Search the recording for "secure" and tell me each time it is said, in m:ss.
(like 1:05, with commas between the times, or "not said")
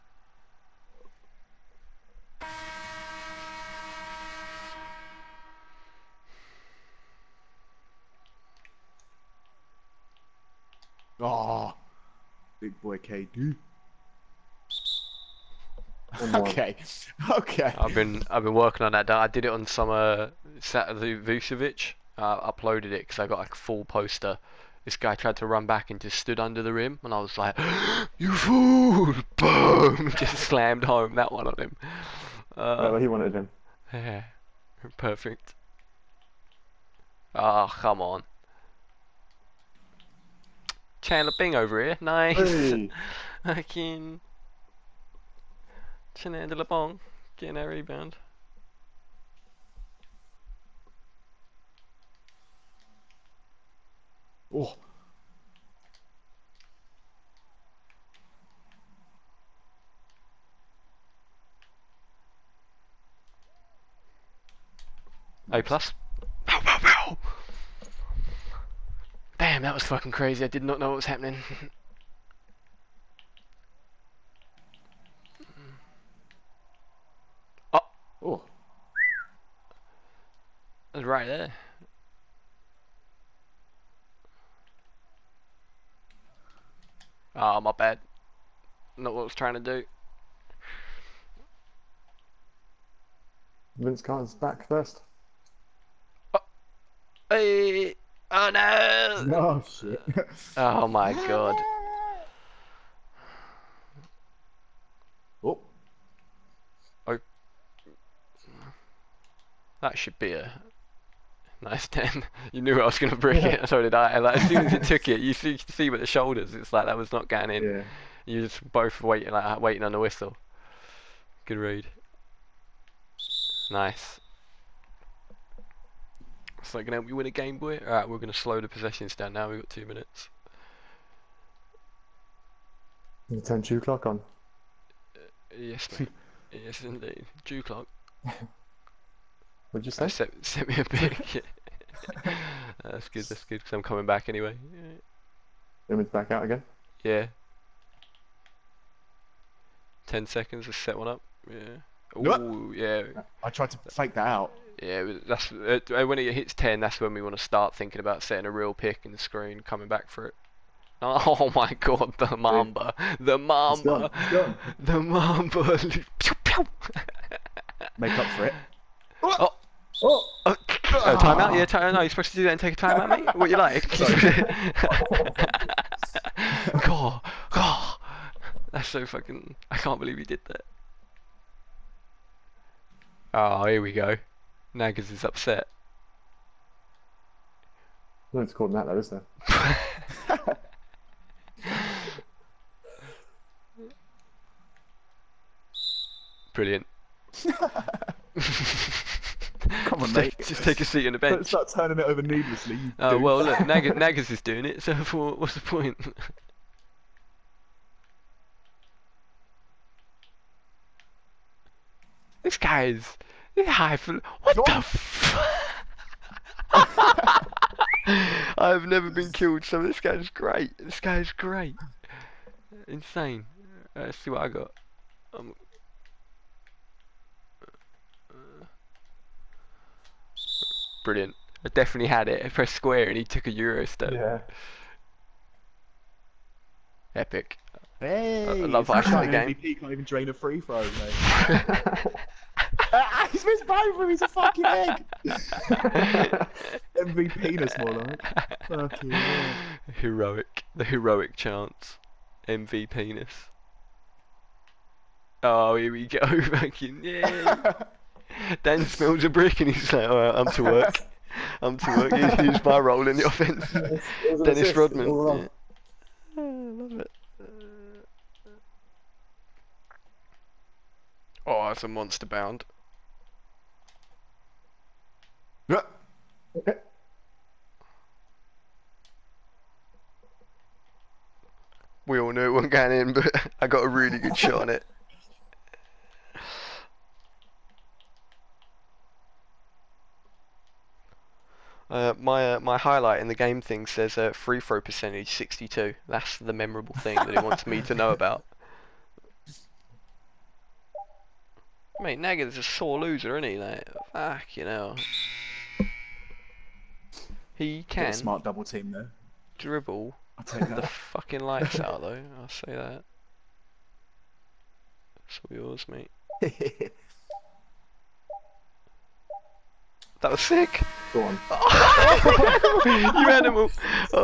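not said.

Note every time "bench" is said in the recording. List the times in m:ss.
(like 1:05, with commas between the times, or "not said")
3:21.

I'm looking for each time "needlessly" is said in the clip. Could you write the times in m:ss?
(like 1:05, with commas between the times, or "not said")
3:22.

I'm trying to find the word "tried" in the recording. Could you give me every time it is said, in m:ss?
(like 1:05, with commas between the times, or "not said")
0:25, 2:33.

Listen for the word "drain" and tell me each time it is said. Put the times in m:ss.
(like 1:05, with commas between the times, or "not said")
4:00.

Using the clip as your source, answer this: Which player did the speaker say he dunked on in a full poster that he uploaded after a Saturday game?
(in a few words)
Vucevic.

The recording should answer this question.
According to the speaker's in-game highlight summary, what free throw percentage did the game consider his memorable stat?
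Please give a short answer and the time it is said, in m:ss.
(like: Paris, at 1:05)
62, at 4:55.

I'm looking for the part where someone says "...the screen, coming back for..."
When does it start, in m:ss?
2:39.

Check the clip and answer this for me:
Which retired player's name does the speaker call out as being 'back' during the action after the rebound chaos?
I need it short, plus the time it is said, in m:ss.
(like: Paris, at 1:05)
Vince Carter, at 1:33.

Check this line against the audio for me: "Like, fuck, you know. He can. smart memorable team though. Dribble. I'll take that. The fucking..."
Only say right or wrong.
wrong.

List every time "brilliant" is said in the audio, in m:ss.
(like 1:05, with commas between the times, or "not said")
3:16, 3:51.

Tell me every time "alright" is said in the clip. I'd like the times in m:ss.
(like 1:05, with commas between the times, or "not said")
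2:07, 4:20.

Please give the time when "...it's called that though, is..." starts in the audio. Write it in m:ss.
3:08.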